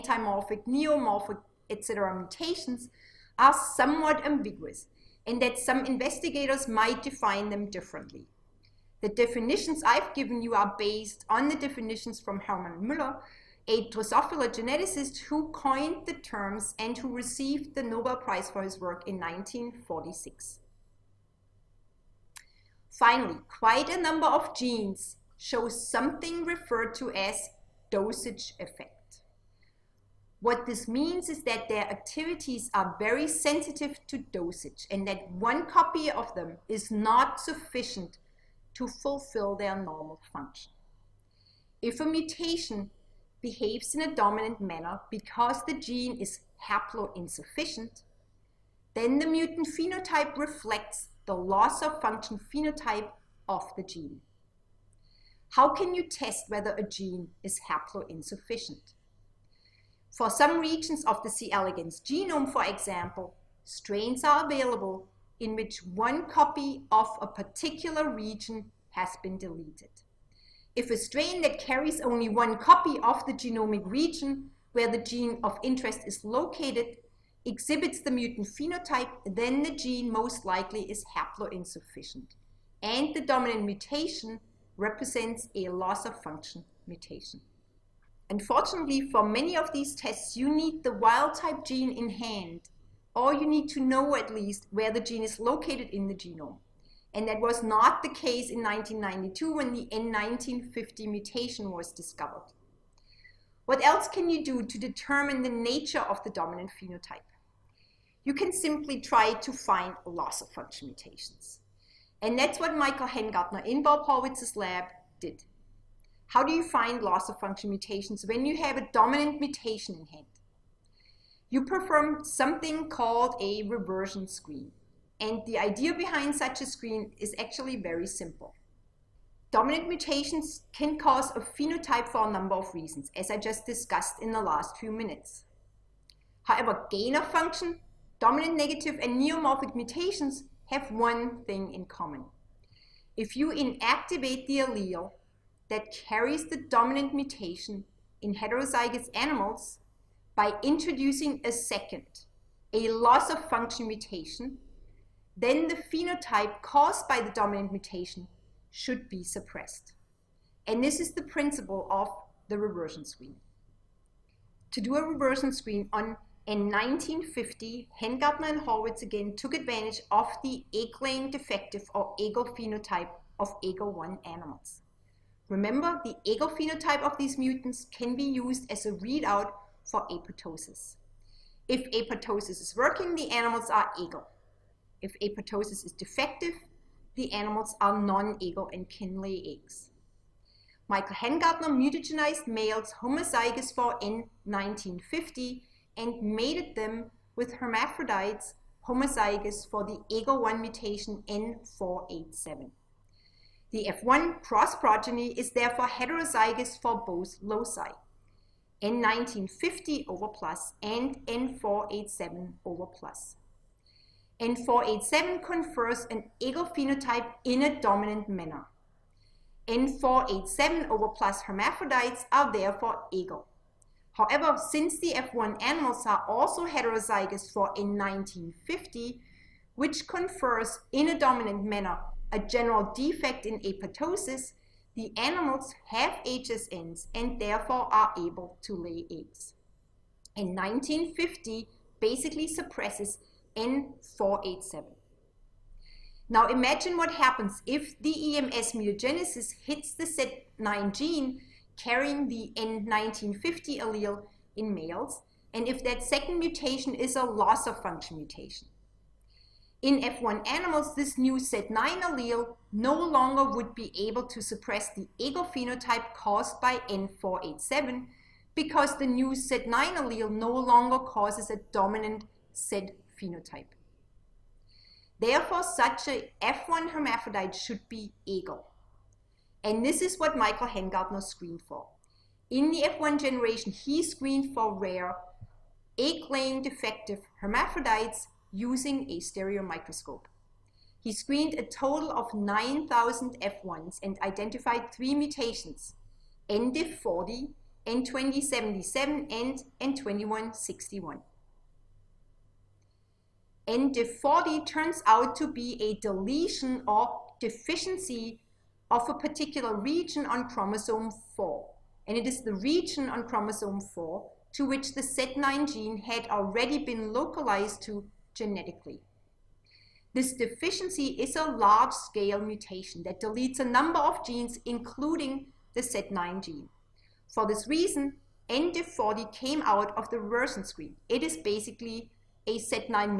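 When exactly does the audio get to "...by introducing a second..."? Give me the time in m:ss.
2:30.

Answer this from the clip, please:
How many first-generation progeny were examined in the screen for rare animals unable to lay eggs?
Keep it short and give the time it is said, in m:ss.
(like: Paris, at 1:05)
9,000, at 4:52.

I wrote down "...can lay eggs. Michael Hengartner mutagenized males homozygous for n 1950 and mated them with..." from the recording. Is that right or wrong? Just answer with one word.
right.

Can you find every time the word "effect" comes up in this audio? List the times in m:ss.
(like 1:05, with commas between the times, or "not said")
0:28.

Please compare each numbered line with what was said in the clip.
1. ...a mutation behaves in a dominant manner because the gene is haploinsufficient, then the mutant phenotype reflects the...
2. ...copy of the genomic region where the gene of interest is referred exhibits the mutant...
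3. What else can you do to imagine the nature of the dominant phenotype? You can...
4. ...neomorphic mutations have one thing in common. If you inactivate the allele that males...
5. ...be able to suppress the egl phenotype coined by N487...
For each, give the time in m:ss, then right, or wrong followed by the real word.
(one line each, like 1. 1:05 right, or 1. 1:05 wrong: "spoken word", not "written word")
1. 0:41 right
2. 1:12 wrong: "located", not "referred"
3. 1:43 wrong: "determine", not "imagine"
4. 2:19 wrong: "carries", not "males"
5. 4:23 wrong: "caused", not "coined".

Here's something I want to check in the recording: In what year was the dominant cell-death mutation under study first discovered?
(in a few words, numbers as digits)
1992.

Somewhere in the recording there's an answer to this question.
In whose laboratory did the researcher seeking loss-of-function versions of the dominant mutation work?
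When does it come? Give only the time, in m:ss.
1:53.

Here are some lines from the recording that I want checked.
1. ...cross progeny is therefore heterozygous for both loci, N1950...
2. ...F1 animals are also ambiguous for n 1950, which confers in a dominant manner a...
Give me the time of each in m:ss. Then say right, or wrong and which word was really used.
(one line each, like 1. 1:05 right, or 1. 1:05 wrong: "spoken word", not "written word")
1. 3:24 right
2. 3:45 wrong: "heterozygous", not "ambiguous".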